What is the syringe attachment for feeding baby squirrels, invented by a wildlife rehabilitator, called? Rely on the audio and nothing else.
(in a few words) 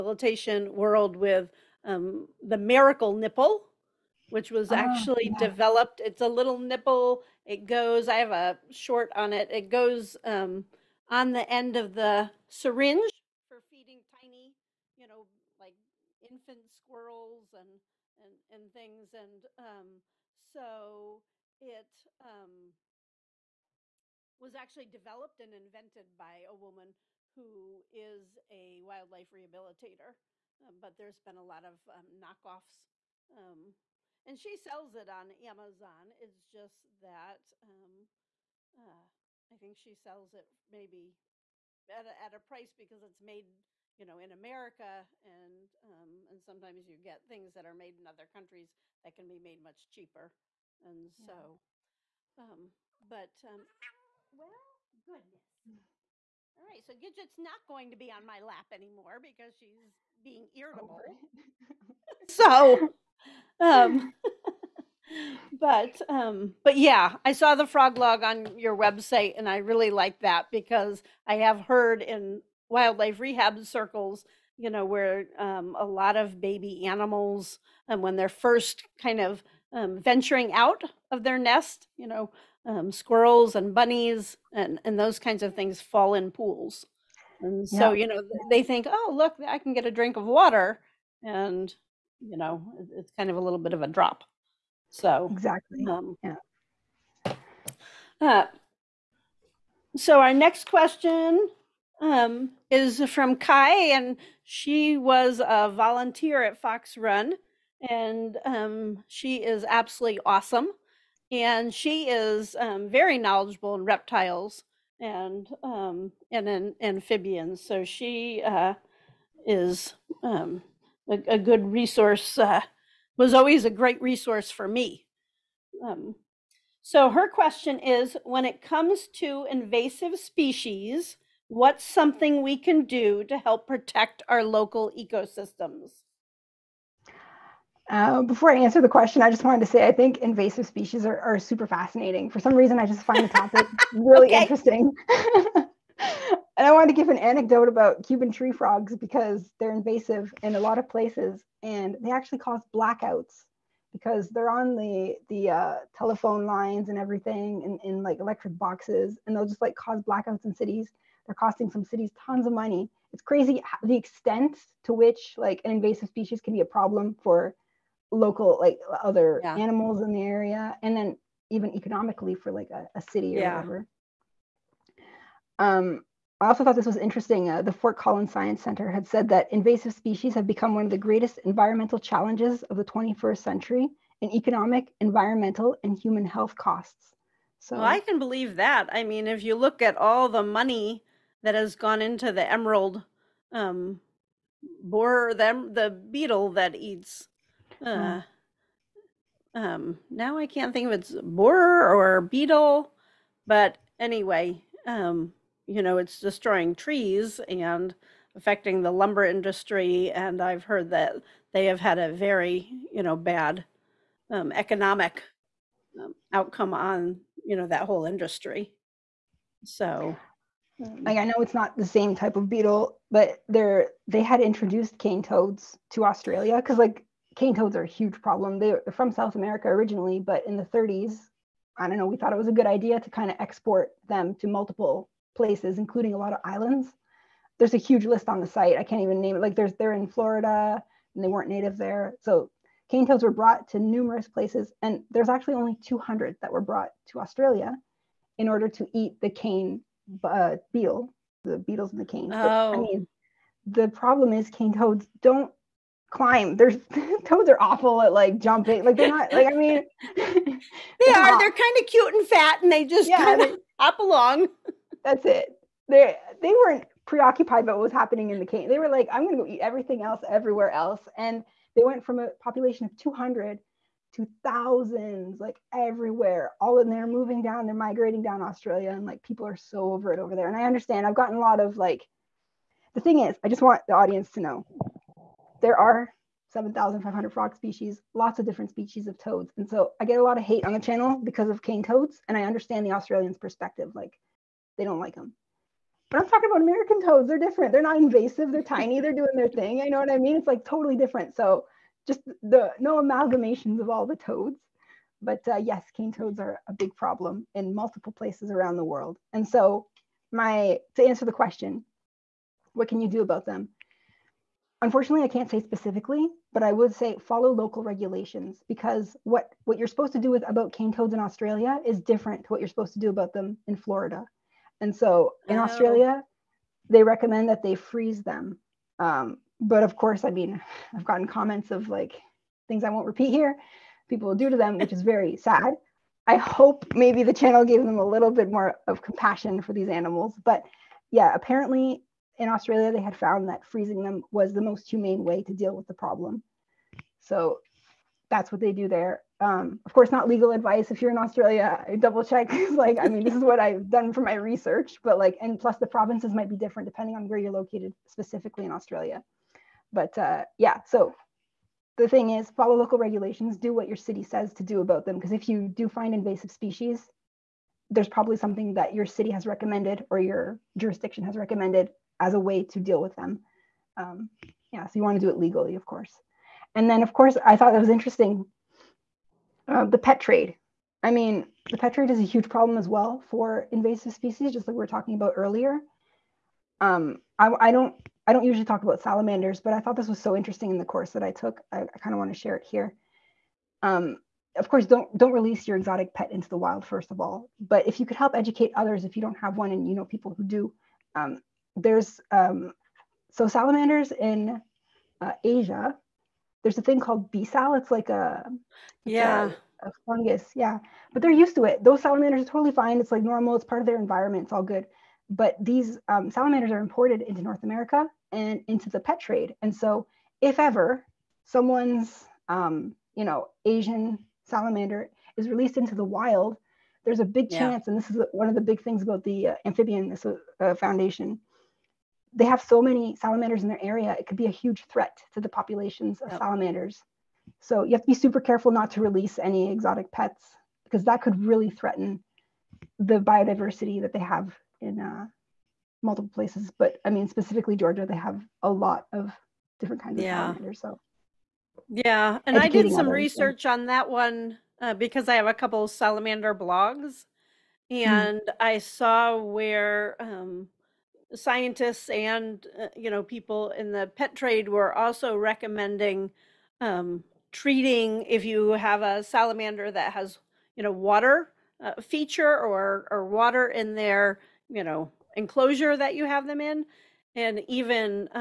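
miracle nipple.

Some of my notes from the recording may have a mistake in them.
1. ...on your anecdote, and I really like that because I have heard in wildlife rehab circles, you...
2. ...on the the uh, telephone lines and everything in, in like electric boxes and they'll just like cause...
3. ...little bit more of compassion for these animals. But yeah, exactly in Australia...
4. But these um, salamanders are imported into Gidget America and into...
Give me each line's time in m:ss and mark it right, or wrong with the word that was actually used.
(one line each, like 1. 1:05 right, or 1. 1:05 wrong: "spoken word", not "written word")
1. 1:08 wrong: "website", not "anecdote"
2. 2:34 right
3. 5:38 wrong: "apparently", not "exactly"
4. 6:55 wrong: "North", not "Gidget".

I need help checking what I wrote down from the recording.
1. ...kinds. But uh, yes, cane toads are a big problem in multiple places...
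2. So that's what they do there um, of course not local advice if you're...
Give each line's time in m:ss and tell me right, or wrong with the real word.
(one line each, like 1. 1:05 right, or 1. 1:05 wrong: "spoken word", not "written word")
1. 5:04 wrong: "toads", not "kinds"
2. 5:47 wrong: "legal", not "local".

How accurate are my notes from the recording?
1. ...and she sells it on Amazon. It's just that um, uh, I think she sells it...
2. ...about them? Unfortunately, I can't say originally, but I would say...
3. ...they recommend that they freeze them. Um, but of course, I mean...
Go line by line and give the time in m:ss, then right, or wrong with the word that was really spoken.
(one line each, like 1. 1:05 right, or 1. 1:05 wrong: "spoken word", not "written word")
1. 0:34 right
2. 5:13 wrong: "specifically", not "originally"
3. 5:26 right.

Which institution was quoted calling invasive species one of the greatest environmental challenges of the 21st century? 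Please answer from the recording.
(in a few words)
Fort Collins Science Center.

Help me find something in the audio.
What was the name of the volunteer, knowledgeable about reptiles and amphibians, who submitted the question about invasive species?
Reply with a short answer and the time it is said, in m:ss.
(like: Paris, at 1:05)
Kai, at 1:43.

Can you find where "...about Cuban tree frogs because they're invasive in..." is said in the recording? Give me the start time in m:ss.
2:27.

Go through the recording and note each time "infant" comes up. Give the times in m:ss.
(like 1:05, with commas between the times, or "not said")
0:16.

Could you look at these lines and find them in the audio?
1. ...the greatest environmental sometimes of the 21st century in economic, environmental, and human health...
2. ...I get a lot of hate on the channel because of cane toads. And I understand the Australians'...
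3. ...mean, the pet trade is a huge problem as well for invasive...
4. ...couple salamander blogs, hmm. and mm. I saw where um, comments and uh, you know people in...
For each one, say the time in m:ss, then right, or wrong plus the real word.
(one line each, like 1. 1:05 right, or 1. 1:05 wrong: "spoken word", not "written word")
1. 3:00 wrong: "challenges", not "sometimes"
2. 4:49 right
3. 6:21 right
4. 7:35 wrong: "scientists", not "comments".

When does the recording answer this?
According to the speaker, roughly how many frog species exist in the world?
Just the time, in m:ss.
4:46.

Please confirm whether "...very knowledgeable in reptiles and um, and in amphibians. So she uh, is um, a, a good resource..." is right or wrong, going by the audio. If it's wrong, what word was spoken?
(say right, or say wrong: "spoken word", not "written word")
right.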